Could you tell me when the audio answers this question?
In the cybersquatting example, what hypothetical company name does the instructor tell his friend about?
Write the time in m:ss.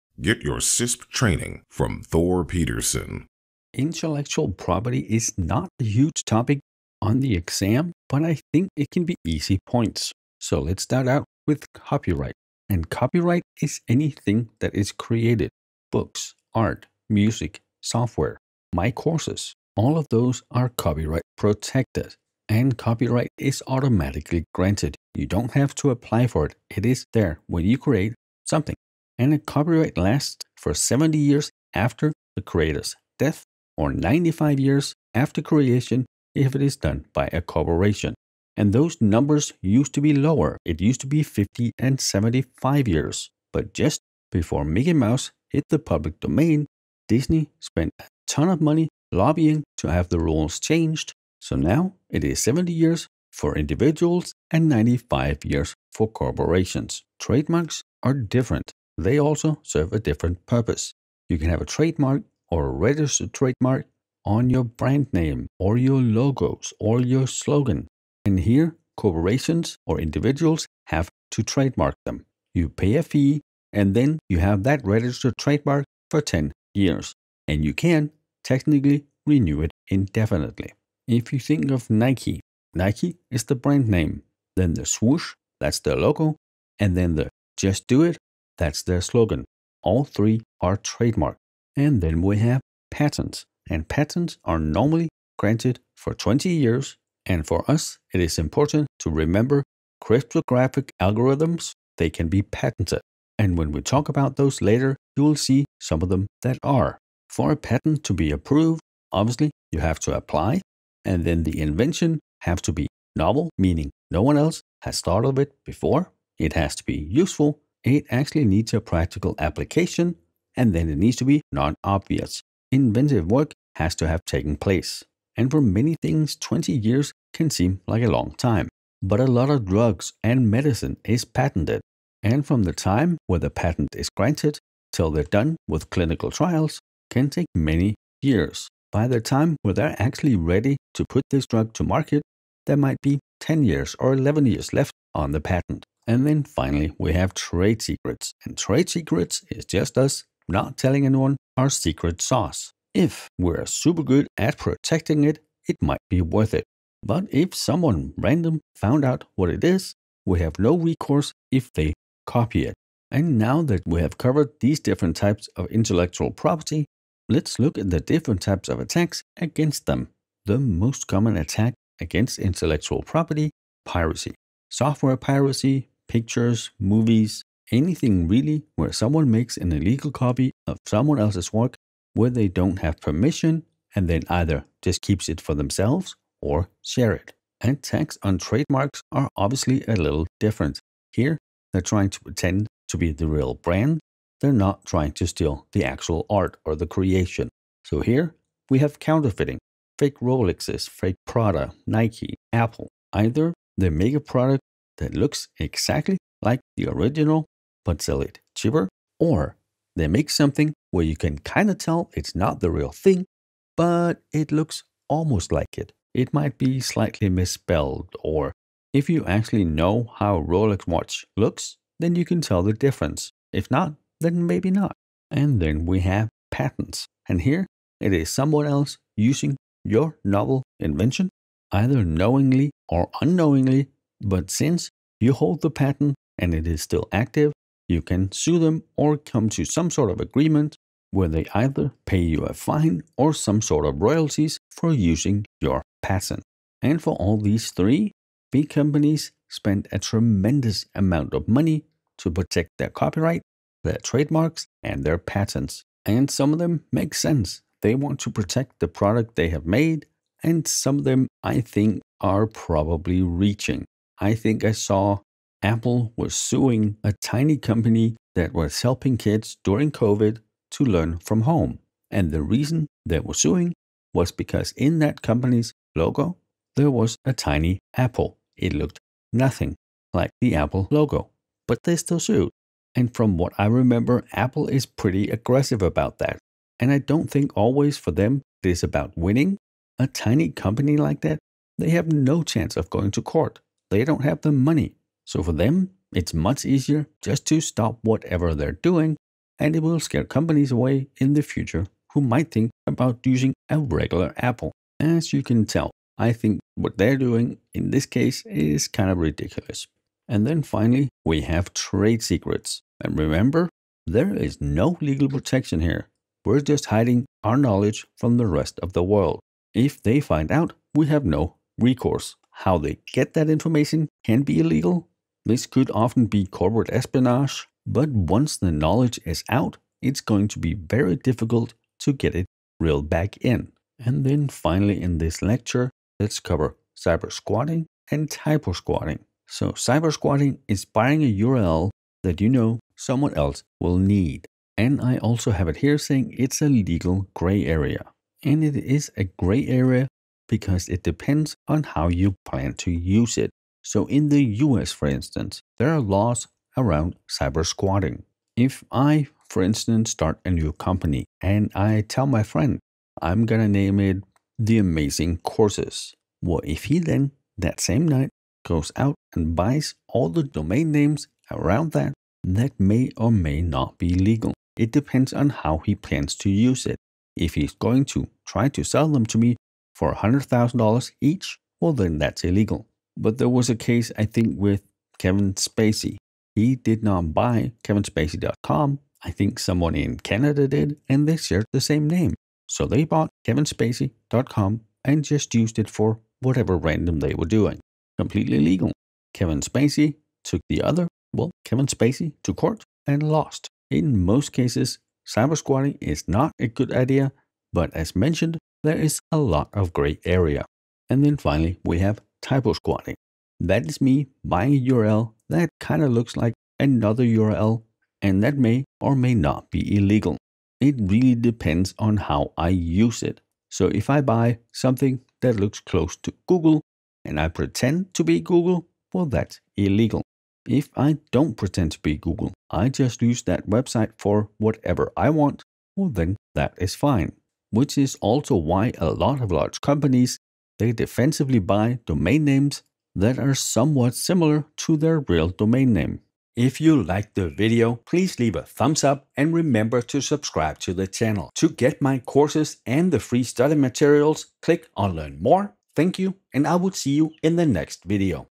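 6:04.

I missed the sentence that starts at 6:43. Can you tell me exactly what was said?
In most cases, cyber squatting is not a good idea, but as mentioned, there is a lot of gray area.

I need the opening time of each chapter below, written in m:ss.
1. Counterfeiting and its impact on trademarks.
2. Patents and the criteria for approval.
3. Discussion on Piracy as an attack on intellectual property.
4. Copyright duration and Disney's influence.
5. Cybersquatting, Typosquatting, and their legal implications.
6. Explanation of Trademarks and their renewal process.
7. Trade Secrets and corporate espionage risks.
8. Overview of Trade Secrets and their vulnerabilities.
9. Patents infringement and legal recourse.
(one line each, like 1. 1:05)
1. 3:11
2. 1:42
3. 2:50
4. 0:27
5. 5:34
6. 1:17
7. 5:13
8. 2:26
9. 4:07.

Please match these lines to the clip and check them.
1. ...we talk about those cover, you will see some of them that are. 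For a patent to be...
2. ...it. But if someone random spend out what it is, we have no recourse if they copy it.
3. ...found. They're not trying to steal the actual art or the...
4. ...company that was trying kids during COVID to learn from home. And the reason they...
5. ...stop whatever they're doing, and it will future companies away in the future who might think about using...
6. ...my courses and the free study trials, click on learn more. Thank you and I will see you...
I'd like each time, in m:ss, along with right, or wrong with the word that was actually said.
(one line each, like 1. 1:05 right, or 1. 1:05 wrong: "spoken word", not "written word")
1. 1:43 wrong: "later", not "cover"
2. 2:36 wrong: "found", not "spend"
3. 3:13 wrong: "brand", not "found"
4. 4:27 wrong: "helping", not "trying"
5. 4:57 wrong: "scare", not "future"
6. 7:32 wrong: "materials", not "trials".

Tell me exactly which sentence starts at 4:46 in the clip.
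And I don't think always for them it is about winning.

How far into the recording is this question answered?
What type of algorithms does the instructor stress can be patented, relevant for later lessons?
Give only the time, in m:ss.
1:40.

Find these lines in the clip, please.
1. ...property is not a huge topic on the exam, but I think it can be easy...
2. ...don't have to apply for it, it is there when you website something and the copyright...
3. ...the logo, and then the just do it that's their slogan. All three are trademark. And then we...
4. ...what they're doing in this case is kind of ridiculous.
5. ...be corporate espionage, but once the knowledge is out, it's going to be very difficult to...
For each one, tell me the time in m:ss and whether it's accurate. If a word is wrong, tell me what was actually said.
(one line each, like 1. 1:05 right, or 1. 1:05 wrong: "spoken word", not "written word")
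1. 0:04 right
2. 0:25 wrong: "create", not "website"
3. 1:25 right
4. 5:06 right
5. 5:26 right.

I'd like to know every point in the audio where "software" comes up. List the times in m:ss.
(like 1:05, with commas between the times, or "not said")
0:17, 2:54.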